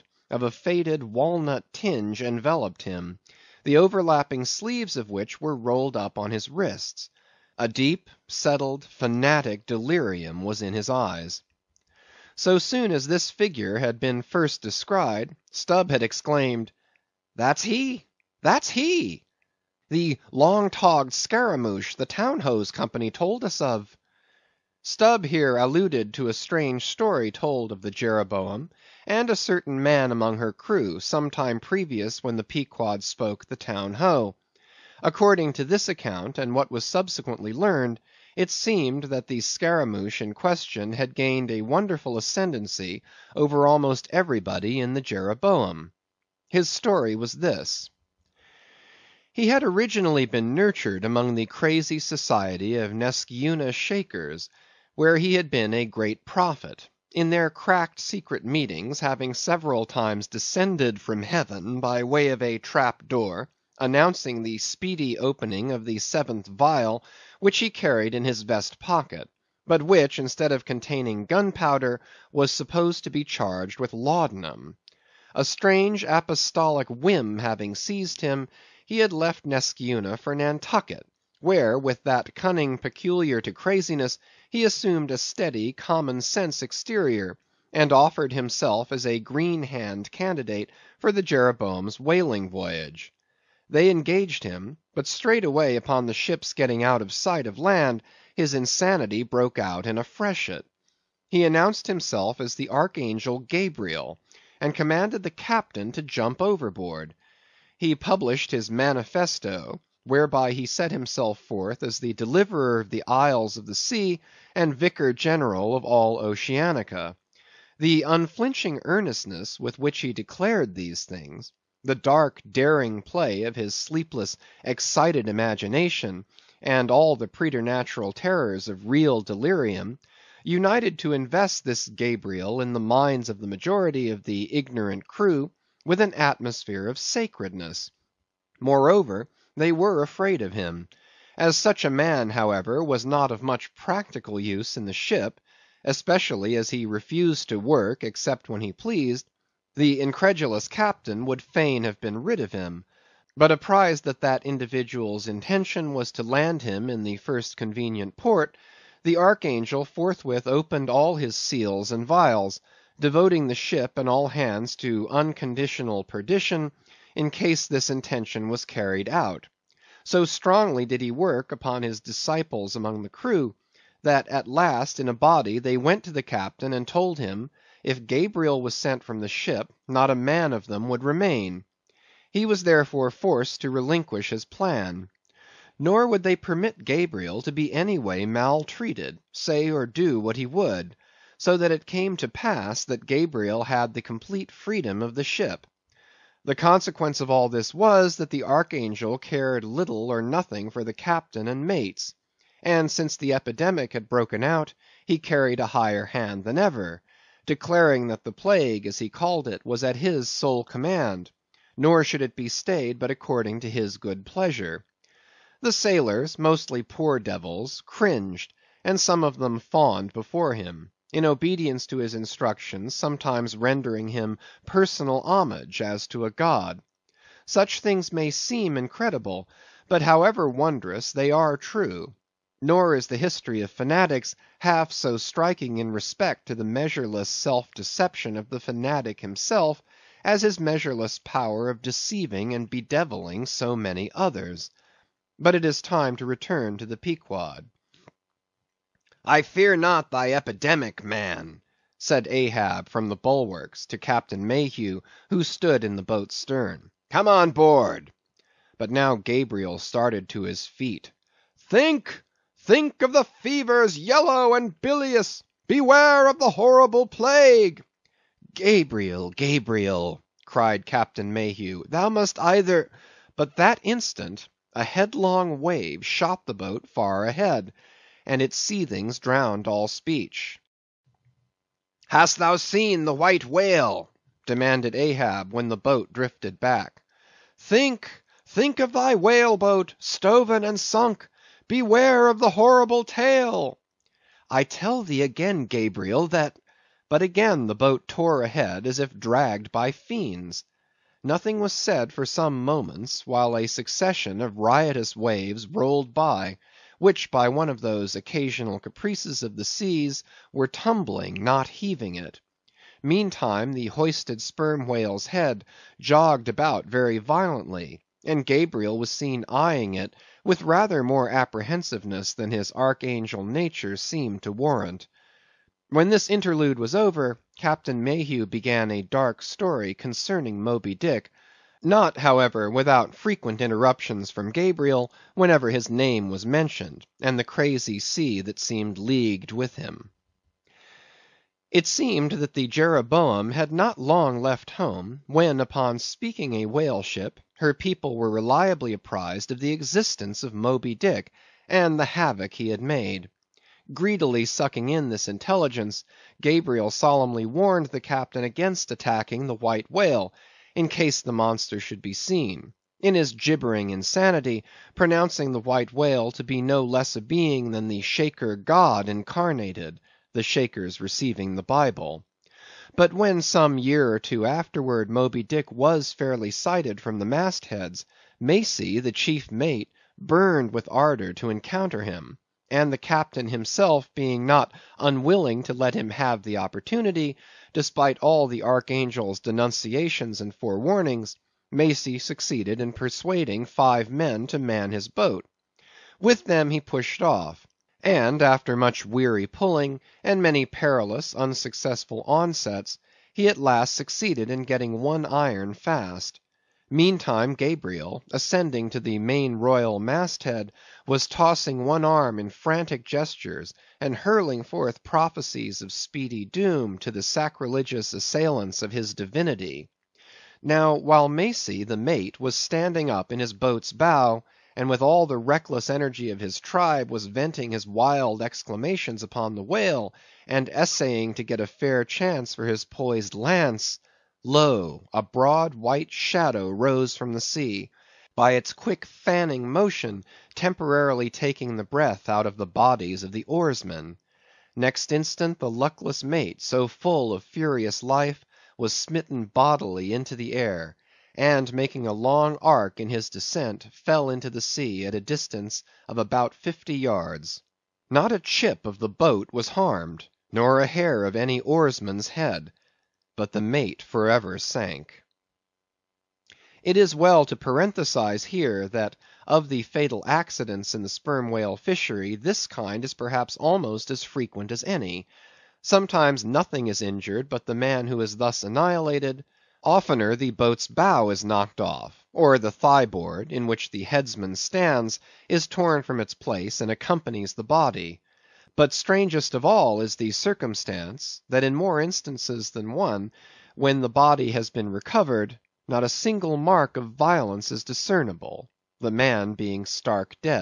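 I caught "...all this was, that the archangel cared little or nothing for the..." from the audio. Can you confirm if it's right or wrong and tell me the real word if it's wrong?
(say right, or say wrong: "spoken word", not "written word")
right.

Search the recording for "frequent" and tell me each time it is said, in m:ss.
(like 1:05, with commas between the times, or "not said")
5:33, 7:54.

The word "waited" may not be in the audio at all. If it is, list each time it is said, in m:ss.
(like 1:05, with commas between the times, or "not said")
not said.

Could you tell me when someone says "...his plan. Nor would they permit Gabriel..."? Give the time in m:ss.
3:04.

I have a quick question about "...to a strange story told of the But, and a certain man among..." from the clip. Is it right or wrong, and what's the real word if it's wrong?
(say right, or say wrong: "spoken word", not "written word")
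wrong: "Jeroboam", not "But".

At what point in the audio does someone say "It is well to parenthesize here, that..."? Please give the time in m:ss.
7:46.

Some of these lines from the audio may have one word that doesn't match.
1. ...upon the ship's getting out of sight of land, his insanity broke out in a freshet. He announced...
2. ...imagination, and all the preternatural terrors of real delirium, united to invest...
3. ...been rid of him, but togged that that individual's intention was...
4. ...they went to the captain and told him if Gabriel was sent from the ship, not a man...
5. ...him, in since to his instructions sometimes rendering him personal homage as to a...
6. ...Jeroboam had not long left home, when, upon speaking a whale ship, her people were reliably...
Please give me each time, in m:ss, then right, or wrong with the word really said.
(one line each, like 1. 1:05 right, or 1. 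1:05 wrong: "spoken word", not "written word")
1. 1:35 right
2. 2:05 right
3. 2:32 wrong: "apprised", not "togged"
4. 2:55 right
5. 3:40 wrong: "obedience", not "since"
6. 5:42 right.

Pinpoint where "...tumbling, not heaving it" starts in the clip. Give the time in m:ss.
5:10.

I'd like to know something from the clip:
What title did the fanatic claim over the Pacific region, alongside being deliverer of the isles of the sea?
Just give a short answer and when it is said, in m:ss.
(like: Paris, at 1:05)
vicar general of all Oceanica, at 1:54.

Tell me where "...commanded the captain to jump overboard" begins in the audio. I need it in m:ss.
1:44.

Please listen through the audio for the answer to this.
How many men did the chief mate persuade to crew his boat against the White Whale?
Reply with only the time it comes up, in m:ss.
6:33.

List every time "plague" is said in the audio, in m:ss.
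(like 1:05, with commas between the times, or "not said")
3:28, 4:27.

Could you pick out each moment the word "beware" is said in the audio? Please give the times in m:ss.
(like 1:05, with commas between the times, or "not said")
4:25, 4:51.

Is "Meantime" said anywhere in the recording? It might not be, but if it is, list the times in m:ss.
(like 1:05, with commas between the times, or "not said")
5:13, 6:46.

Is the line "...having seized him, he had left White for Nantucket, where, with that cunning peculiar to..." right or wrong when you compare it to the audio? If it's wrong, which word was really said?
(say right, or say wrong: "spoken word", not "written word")
wrong: "Neskyeuna", not "White".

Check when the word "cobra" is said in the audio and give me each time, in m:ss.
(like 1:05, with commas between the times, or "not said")
not said.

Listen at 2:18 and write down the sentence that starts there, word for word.
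Moreover, they were afraid of him.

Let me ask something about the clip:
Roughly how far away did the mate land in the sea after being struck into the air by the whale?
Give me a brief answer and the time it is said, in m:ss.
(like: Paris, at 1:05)
about 50 yards, at 7:36.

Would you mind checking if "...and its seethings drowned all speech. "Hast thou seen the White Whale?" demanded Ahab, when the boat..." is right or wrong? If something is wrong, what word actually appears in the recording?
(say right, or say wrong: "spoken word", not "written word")
right.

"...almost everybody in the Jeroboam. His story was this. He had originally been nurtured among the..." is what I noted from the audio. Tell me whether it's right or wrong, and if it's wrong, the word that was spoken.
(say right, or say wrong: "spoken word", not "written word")
right.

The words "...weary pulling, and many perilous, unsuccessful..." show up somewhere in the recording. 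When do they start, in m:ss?
6:39.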